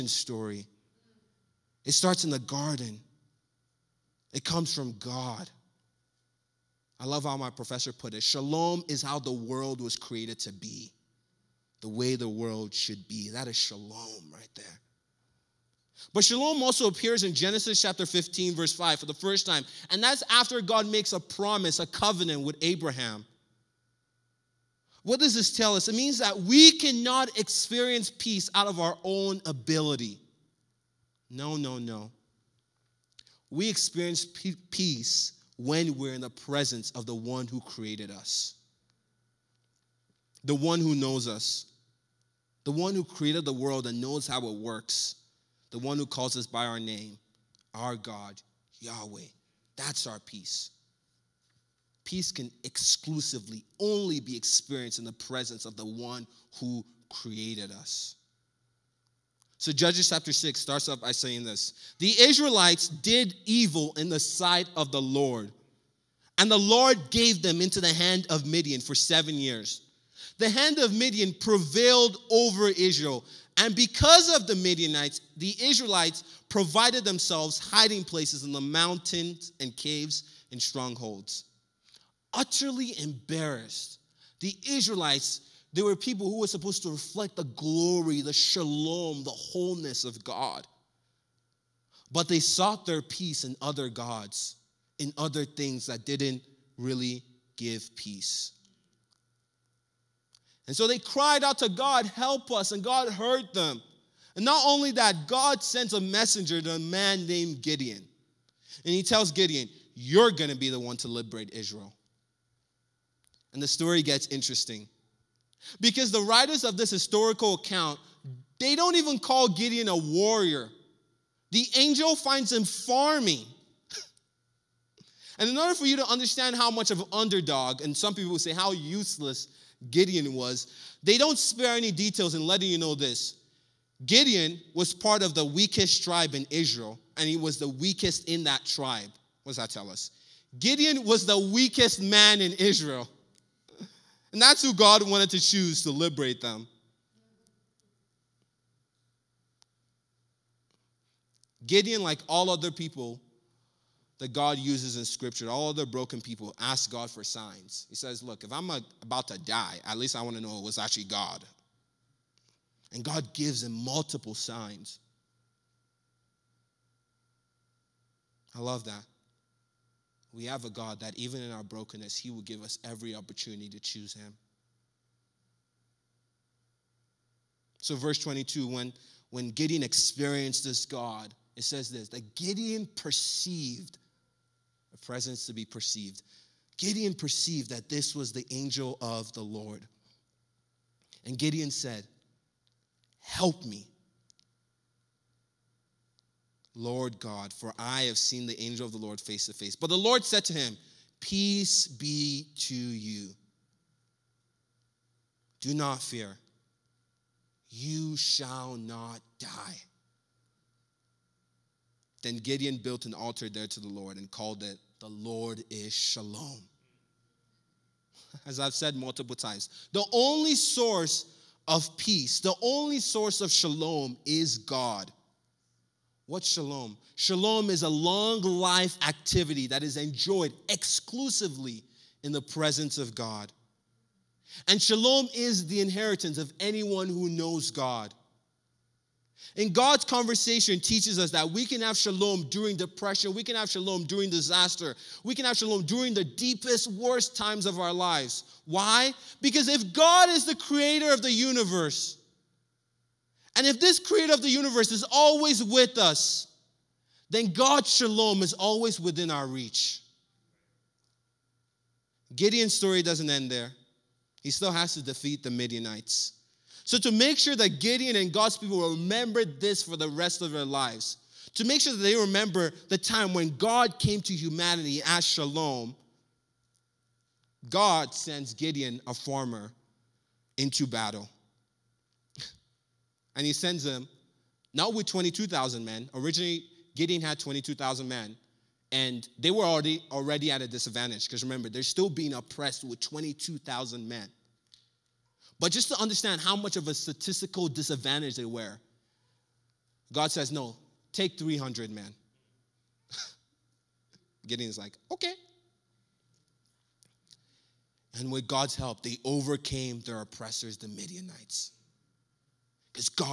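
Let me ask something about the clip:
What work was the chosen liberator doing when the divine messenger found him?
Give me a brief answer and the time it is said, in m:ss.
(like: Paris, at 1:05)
Farming, at 2:02.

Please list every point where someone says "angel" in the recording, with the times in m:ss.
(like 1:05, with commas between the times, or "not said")
2:01, 3:08, 3:18.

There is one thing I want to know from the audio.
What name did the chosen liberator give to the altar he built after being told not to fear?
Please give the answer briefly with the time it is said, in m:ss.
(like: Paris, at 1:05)
The Lord is shalom, at 3:34.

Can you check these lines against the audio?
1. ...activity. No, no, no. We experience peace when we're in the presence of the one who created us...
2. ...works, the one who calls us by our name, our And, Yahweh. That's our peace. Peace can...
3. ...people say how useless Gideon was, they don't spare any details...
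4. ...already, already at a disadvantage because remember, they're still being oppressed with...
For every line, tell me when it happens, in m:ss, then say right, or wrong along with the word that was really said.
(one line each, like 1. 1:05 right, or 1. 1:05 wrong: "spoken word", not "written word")
1. 0:29 wrong: "ability", not "activity"
2. 0:44 wrong: "God", not "And"
3. 2:08 right
4. 4:49 right.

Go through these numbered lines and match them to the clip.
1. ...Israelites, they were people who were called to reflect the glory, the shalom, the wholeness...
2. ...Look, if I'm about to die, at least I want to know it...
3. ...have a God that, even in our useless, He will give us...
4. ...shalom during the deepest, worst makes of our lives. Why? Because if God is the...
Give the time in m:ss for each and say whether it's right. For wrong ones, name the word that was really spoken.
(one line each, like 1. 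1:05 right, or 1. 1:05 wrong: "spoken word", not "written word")
1. 1:24 wrong: "supposed", not "called"
2. 2:38 right
3. 2:50 wrong: "brokenness", not "useless"
4. 4:05 wrong: "times", not "makes".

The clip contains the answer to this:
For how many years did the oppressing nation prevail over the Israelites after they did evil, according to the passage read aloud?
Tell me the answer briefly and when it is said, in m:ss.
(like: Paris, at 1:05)
7 years, at 1:08.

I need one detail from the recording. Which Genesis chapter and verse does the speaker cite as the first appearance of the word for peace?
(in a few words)
Genesis 15:5.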